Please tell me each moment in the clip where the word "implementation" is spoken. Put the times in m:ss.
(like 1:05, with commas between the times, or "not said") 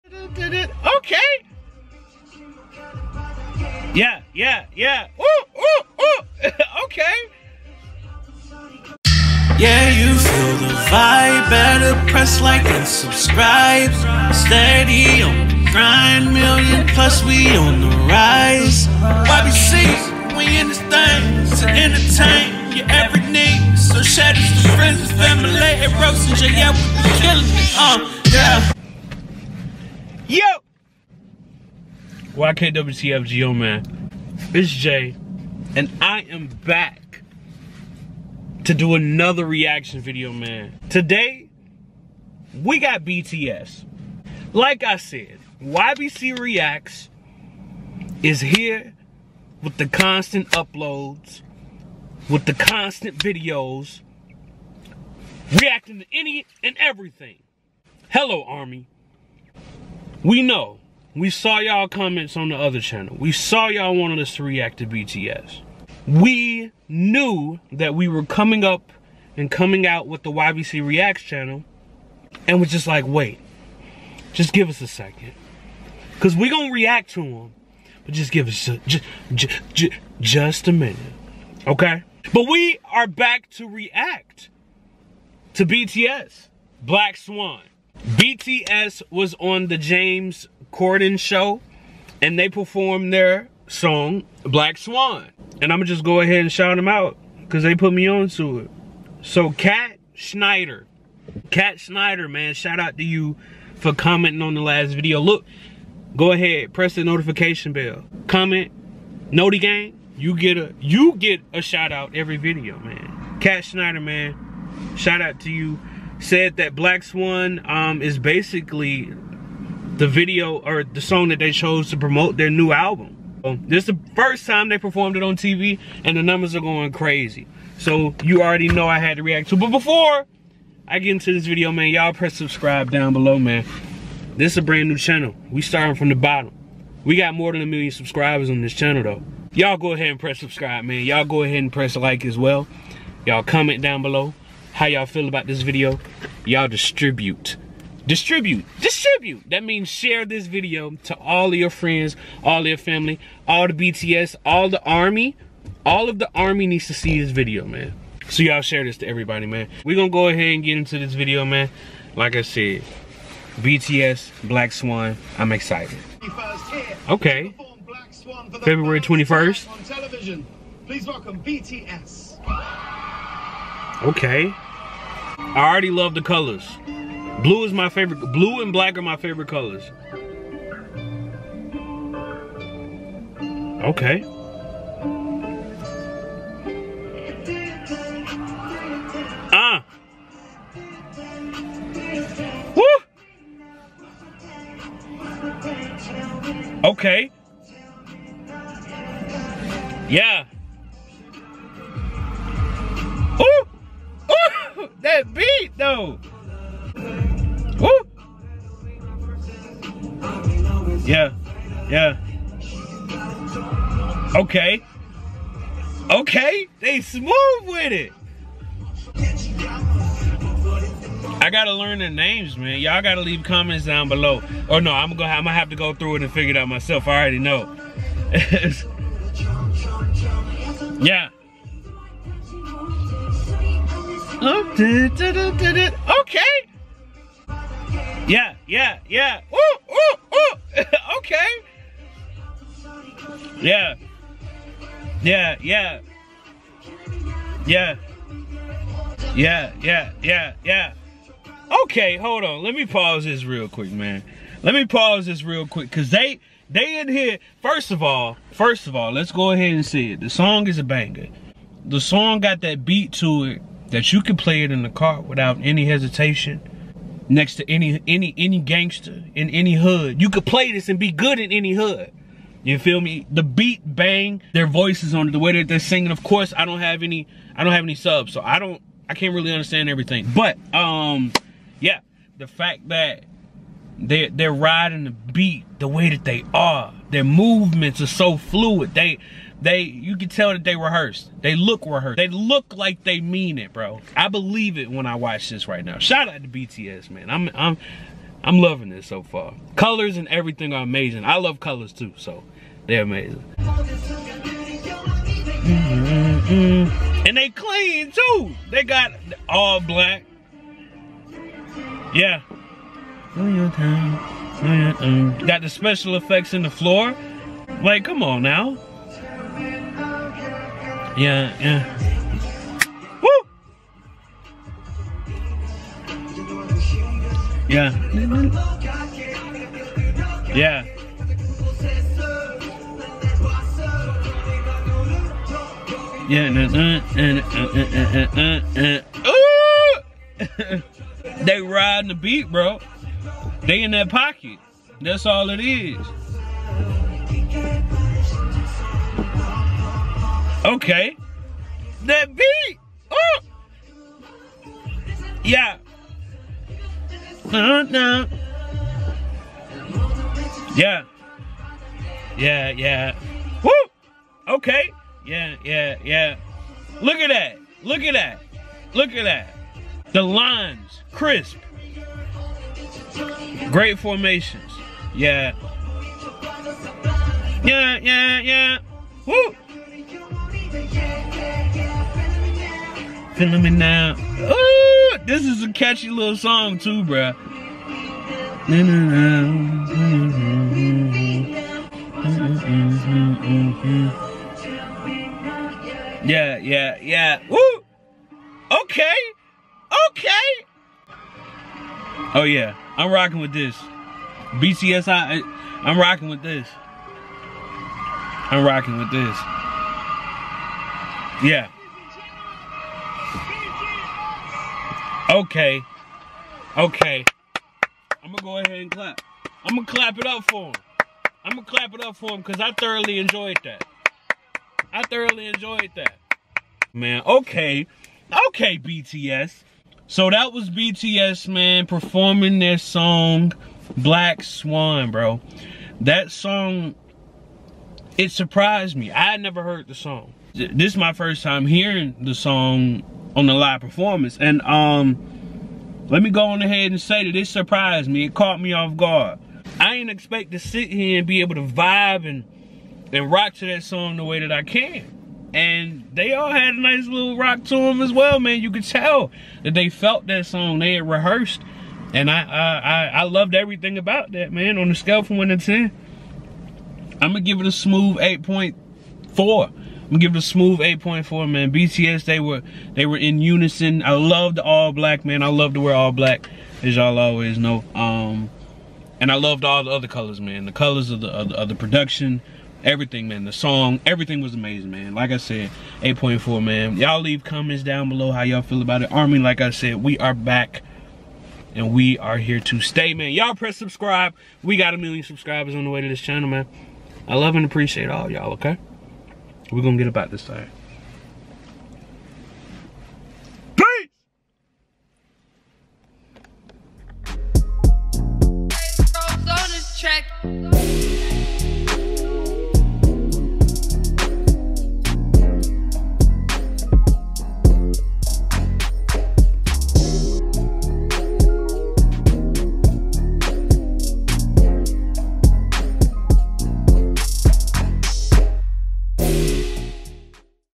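not said.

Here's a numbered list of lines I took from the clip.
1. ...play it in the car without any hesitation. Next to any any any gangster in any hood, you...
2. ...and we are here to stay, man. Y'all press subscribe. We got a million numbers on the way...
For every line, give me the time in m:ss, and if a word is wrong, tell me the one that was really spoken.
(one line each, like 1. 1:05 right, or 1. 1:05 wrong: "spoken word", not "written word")
1. 4:24 right
2. 8:11 wrong: "subscribers", not "numbers".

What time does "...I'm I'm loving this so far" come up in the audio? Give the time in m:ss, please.
4:57.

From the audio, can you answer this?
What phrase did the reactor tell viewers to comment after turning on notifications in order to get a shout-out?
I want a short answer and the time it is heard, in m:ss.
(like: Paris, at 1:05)
Noti Gang, at 1:49.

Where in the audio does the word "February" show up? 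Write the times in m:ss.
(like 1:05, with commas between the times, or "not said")
2:48.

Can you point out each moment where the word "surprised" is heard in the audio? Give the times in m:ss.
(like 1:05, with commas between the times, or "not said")
7:18, 7:27.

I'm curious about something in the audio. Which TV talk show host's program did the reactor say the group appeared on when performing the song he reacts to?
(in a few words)
James Corden.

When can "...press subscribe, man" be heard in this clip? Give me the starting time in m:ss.
2:20.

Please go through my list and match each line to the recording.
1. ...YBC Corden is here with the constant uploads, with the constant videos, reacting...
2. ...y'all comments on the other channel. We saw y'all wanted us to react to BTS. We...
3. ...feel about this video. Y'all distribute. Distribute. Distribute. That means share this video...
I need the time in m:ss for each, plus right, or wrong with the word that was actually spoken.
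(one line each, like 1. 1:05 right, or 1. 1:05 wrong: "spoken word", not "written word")
1. 0:45 wrong: "Reacts", not "Corden"
2. 1:01 right
3. 2:25 right.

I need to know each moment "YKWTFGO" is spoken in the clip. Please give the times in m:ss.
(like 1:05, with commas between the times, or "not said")
0:32.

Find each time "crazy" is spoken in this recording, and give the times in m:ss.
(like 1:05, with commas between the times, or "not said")
2:06.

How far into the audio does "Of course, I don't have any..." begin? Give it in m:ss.
4:36.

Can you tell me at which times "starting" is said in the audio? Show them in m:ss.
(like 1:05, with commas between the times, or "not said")
2:15.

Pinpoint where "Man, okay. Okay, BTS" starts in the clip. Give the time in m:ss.
7:06.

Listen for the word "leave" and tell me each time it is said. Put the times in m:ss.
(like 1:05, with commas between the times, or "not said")
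3:43, 8:07.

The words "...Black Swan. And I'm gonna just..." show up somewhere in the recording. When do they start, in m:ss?
1:34.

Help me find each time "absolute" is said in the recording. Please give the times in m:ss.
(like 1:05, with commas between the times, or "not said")
not said.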